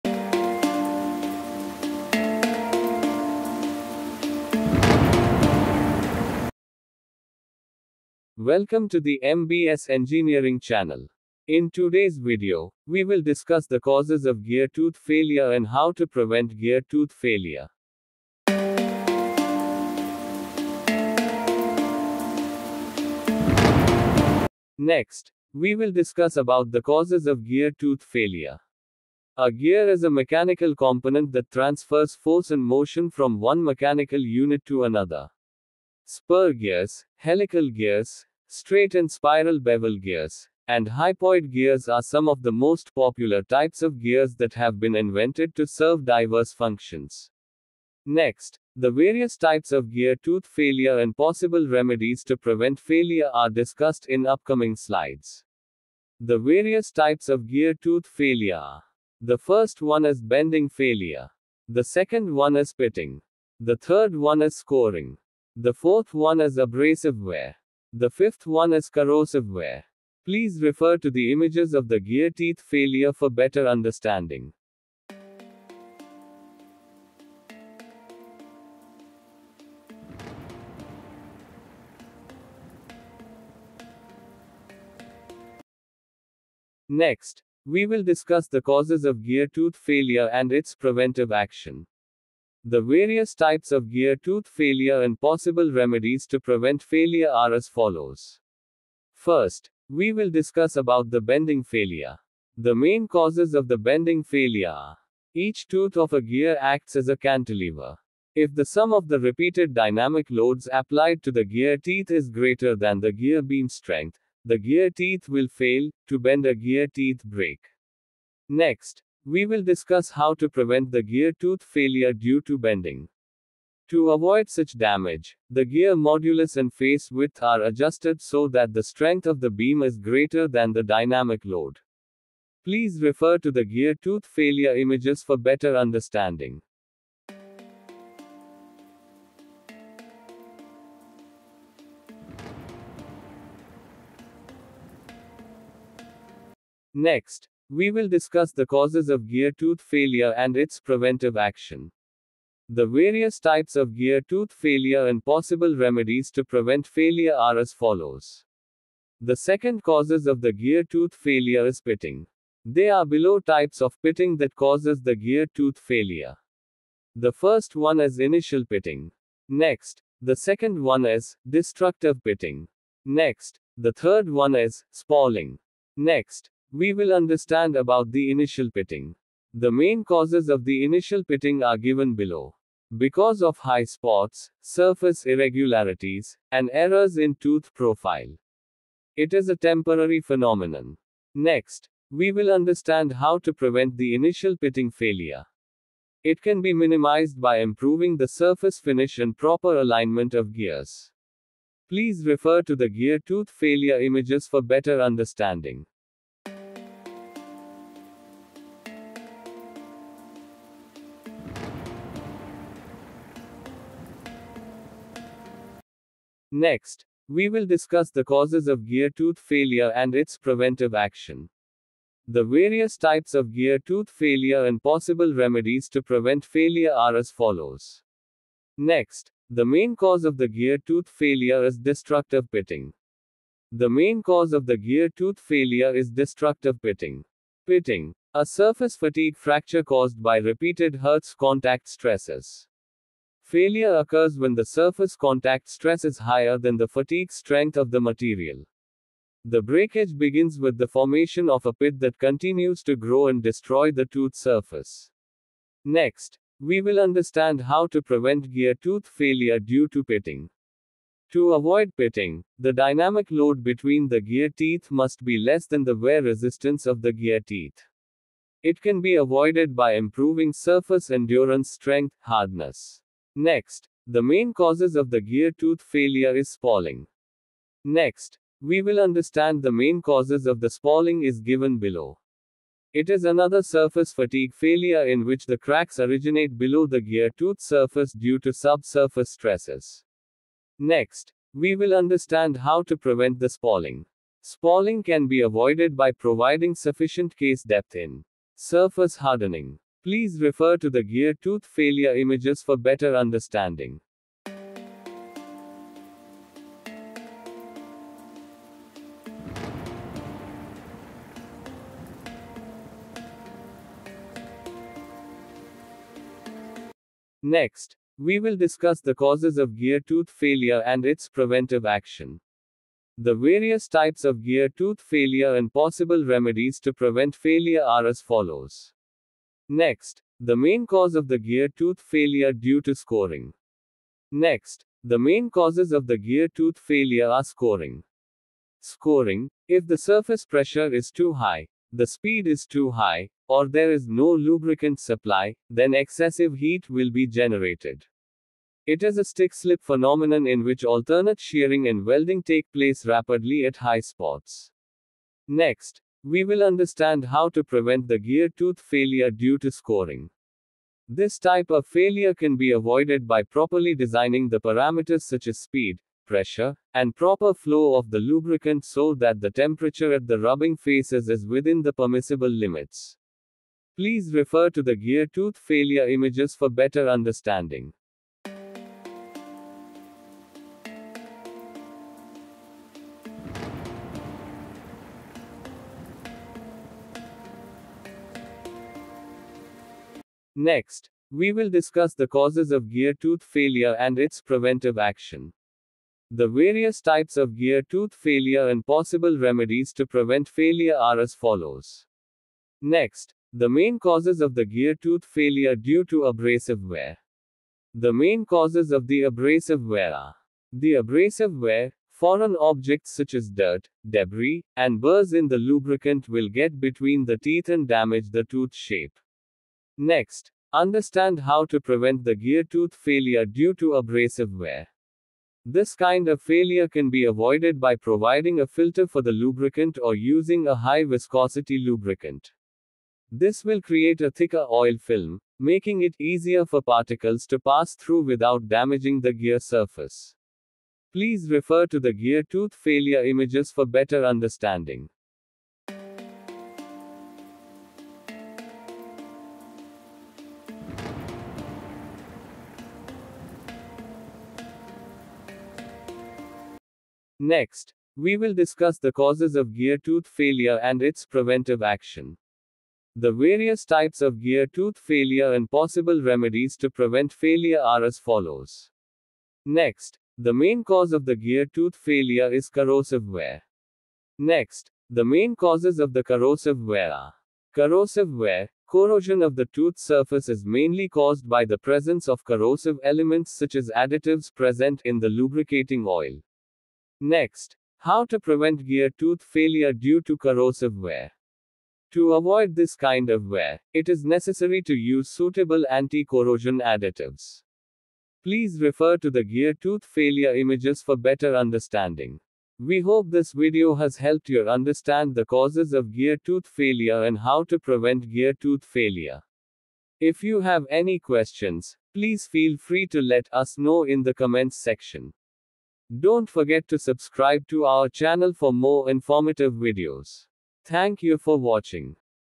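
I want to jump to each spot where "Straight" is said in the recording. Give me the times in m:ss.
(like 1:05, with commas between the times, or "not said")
0:38.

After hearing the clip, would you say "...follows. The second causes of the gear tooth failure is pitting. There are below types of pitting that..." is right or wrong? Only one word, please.
right.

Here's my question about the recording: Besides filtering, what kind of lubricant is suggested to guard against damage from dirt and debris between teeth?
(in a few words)
High viscosity lubricant.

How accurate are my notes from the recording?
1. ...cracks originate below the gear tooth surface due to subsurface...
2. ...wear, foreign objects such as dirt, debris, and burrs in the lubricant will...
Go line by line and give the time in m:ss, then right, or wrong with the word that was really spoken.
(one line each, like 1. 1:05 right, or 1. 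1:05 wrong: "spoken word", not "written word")
1. 4:45 right
2. 6:51 right.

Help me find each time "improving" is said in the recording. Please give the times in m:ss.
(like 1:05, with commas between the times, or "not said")
3:17, 4:29.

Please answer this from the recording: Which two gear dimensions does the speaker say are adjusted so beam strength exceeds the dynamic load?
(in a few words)
Modulus and face width.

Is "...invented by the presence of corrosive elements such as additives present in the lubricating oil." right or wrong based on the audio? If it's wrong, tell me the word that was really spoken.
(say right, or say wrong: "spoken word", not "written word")
wrong: "caused", not "invented".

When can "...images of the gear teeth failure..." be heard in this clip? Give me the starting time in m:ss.
1:11.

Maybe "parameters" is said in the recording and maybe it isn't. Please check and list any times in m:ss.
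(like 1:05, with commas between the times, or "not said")
6:04.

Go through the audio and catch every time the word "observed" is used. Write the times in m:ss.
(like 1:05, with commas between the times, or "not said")
not said.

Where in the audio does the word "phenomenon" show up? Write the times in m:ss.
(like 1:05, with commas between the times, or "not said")
3:10, 5:49.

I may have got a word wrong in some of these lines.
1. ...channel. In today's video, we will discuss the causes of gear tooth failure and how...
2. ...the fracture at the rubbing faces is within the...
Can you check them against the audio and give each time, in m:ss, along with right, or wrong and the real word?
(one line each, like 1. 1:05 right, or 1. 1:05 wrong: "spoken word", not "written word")
1. 0:10 right
2. 6:09 wrong: "temperature", not "fracture".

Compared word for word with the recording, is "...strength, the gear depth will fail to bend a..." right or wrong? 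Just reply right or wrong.
wrong.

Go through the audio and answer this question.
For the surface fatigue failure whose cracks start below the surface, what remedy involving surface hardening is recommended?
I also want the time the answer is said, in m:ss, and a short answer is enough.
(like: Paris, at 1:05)
Sufficient case depth, at 4:56.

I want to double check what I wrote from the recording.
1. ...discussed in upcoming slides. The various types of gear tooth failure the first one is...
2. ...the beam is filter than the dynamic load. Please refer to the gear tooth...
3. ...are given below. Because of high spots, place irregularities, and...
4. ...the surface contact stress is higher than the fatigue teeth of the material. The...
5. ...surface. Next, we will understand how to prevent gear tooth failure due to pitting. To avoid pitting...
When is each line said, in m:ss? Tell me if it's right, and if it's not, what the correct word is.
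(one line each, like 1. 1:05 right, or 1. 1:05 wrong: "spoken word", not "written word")
1. 0:53 right
2. 2:09 wrong: "greater", not "filter"
3. 3:01 wrong: "surface", not "place"
4. 4:04 wrong: "strength", not "teeth"
5. 4:14 right.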